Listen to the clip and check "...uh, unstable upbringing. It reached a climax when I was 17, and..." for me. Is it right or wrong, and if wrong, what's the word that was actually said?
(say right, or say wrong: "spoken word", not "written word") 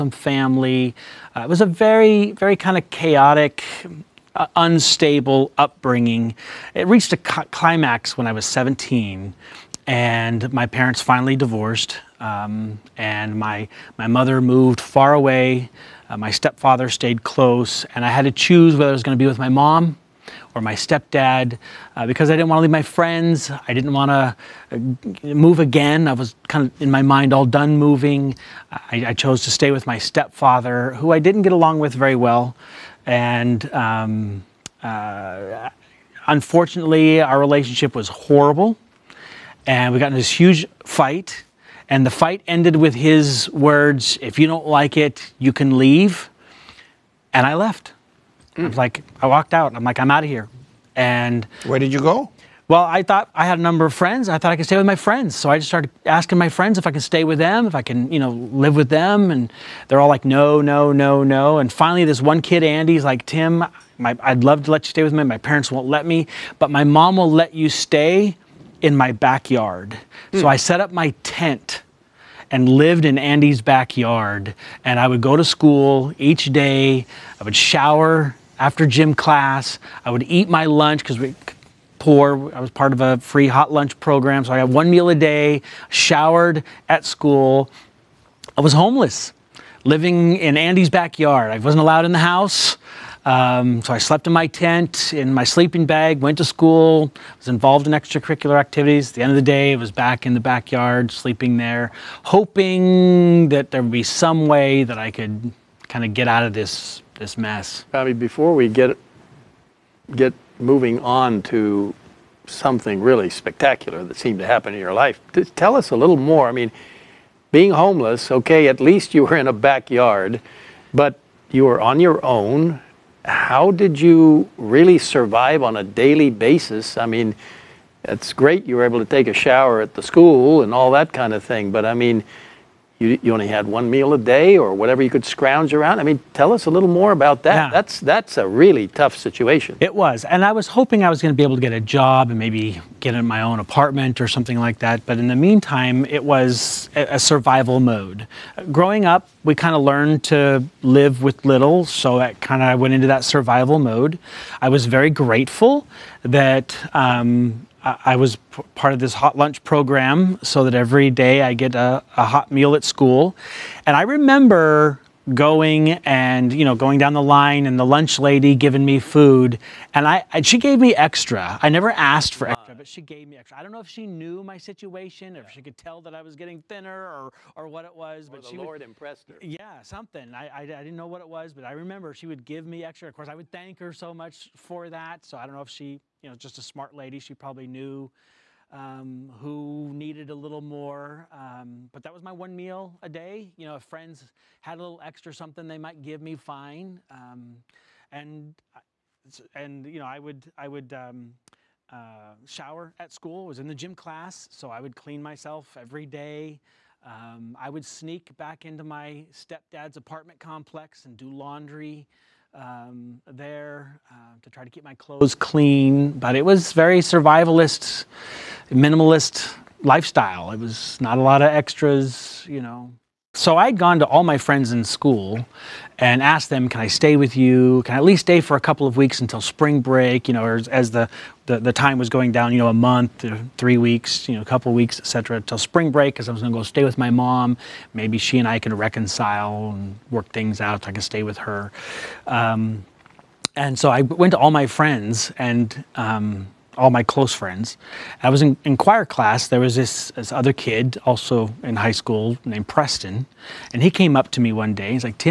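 right.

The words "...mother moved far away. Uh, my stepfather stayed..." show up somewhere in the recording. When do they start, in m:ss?
0:14.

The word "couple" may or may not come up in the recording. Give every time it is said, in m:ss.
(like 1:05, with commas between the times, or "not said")
3:48, 3:54.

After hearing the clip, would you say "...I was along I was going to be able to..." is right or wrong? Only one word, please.
wrong.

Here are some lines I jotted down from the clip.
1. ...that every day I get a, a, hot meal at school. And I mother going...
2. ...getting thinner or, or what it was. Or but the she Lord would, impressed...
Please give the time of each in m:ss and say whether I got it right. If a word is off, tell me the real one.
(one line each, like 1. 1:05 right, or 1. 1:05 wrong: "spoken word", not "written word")
1. 2:40 wrong: "remember", not "mother"
2. 2:56 right.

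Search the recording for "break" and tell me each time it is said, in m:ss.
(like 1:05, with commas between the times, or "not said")
3:49, 3:55.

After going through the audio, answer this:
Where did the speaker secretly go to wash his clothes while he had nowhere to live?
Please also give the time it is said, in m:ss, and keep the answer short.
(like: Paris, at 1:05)
Stepdad's apartment complex, at 3:29.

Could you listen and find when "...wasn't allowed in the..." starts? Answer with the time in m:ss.
1:31.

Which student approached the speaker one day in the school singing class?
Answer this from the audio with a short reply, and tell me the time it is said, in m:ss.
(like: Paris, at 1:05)
Preston, at 4:12.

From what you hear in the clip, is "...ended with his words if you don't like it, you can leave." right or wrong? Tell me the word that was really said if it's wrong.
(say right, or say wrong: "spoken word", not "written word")
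right.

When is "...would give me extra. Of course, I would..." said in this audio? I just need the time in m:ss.
3:02.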